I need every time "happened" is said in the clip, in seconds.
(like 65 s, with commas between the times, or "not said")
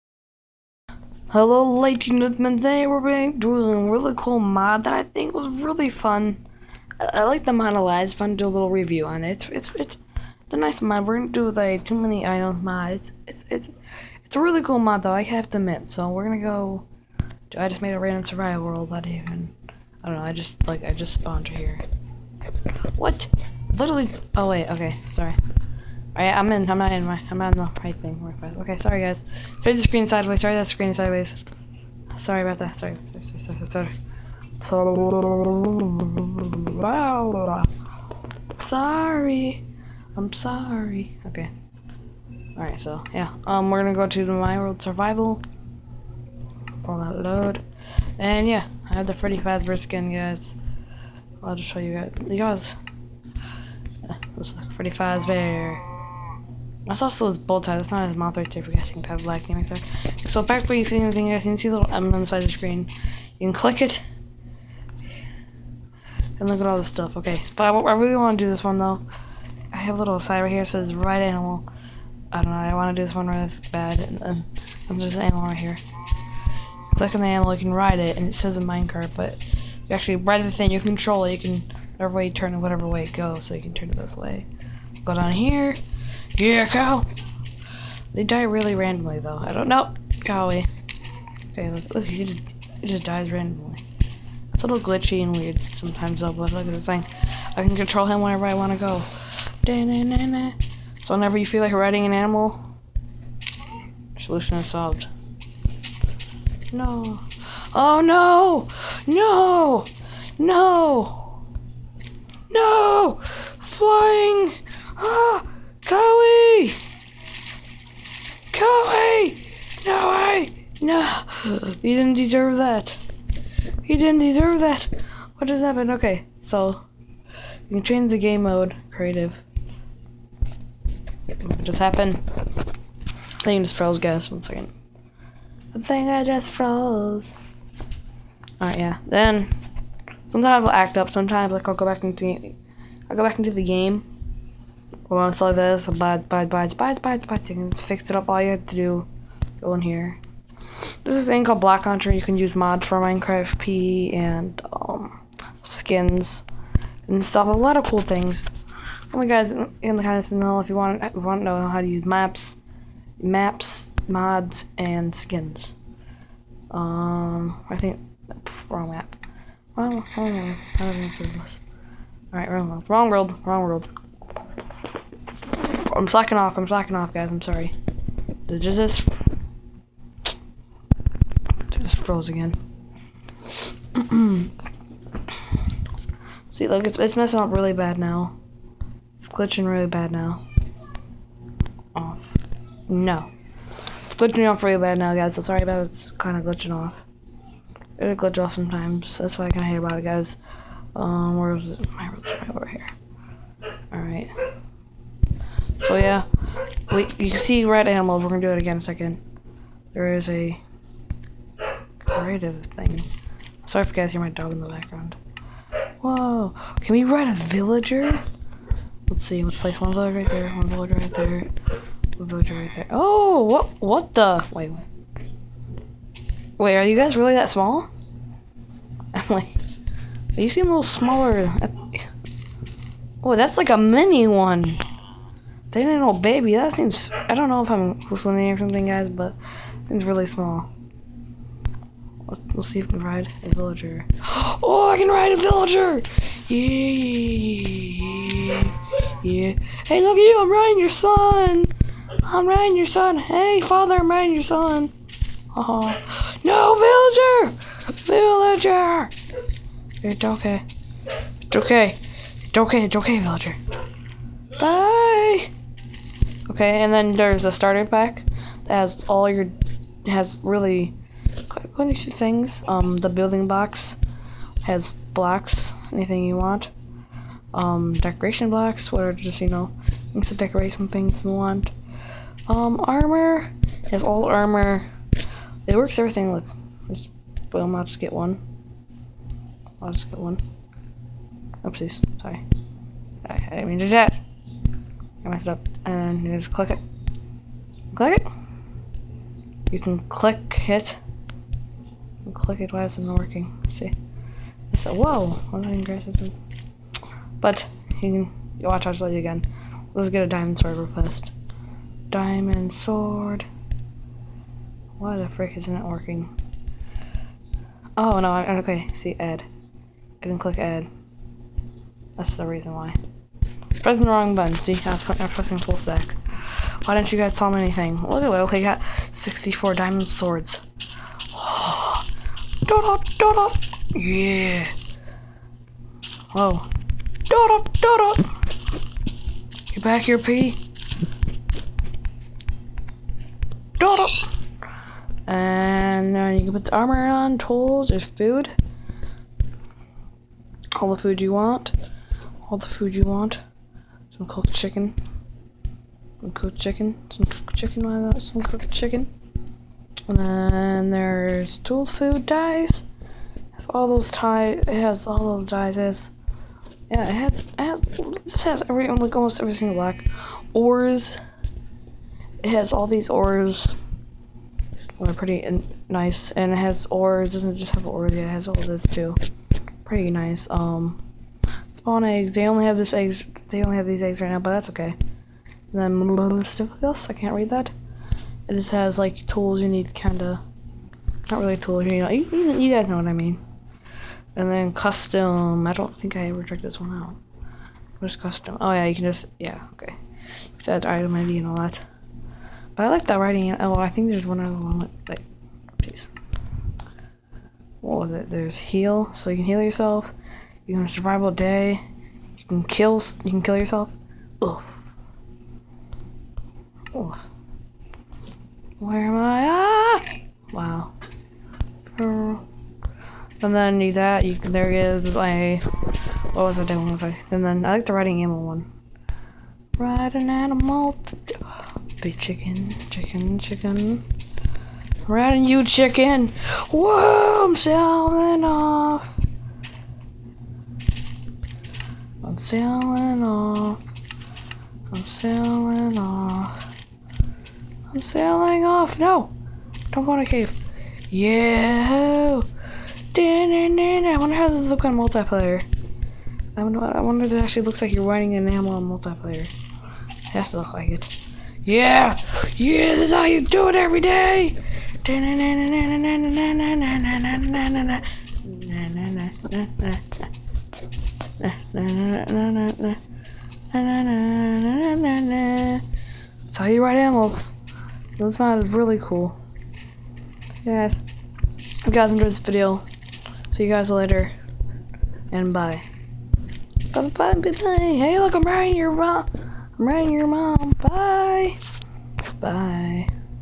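125 s, 131 s.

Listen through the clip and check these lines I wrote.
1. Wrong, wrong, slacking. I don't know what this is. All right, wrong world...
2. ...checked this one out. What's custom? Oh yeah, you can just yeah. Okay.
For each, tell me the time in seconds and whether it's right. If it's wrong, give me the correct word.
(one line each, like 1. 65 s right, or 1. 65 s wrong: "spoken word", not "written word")
1. 169 s wrong: "wrong", not "slacking"
2. 396 s right.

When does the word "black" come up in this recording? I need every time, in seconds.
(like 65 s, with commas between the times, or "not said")
59 s, 369 s.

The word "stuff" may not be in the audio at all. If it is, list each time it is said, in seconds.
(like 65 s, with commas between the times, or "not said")
66 s, 157 s, 386 s.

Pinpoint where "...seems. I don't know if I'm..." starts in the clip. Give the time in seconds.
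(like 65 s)
236 s.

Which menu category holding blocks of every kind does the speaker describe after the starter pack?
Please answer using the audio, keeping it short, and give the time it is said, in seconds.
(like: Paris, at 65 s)
Building box, at 273 s.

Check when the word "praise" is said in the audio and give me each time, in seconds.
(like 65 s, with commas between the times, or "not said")
not said.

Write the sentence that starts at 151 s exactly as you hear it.
This is a thing called BlockLauncher.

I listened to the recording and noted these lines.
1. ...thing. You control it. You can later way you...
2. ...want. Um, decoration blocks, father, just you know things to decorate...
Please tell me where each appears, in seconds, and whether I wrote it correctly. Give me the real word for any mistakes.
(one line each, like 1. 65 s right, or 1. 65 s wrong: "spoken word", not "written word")
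1. 80 s wrong: "whatever", not "later"
2. 276 s wrong: "whatever", not "father".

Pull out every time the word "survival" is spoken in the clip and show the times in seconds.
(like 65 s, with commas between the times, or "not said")
18 s, 44 s, 410 s.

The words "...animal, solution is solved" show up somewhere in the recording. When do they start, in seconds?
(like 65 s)
102 s.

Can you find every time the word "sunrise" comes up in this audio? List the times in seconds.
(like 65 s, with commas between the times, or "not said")
not said.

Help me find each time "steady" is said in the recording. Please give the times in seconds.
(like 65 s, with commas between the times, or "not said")
not said.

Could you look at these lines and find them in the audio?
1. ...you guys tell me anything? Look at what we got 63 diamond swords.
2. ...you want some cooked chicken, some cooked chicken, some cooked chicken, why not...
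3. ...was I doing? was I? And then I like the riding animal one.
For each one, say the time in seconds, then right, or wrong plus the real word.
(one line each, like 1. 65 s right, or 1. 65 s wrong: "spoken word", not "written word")
1. 327 s wrong: "64", not "63"
2. 352 s right
3. 426 s right.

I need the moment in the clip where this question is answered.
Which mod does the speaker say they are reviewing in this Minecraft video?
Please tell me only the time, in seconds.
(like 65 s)
11 s.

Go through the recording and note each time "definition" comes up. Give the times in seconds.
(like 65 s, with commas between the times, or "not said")
not said.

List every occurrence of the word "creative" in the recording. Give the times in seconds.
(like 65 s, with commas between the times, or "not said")
128 s, 211 s.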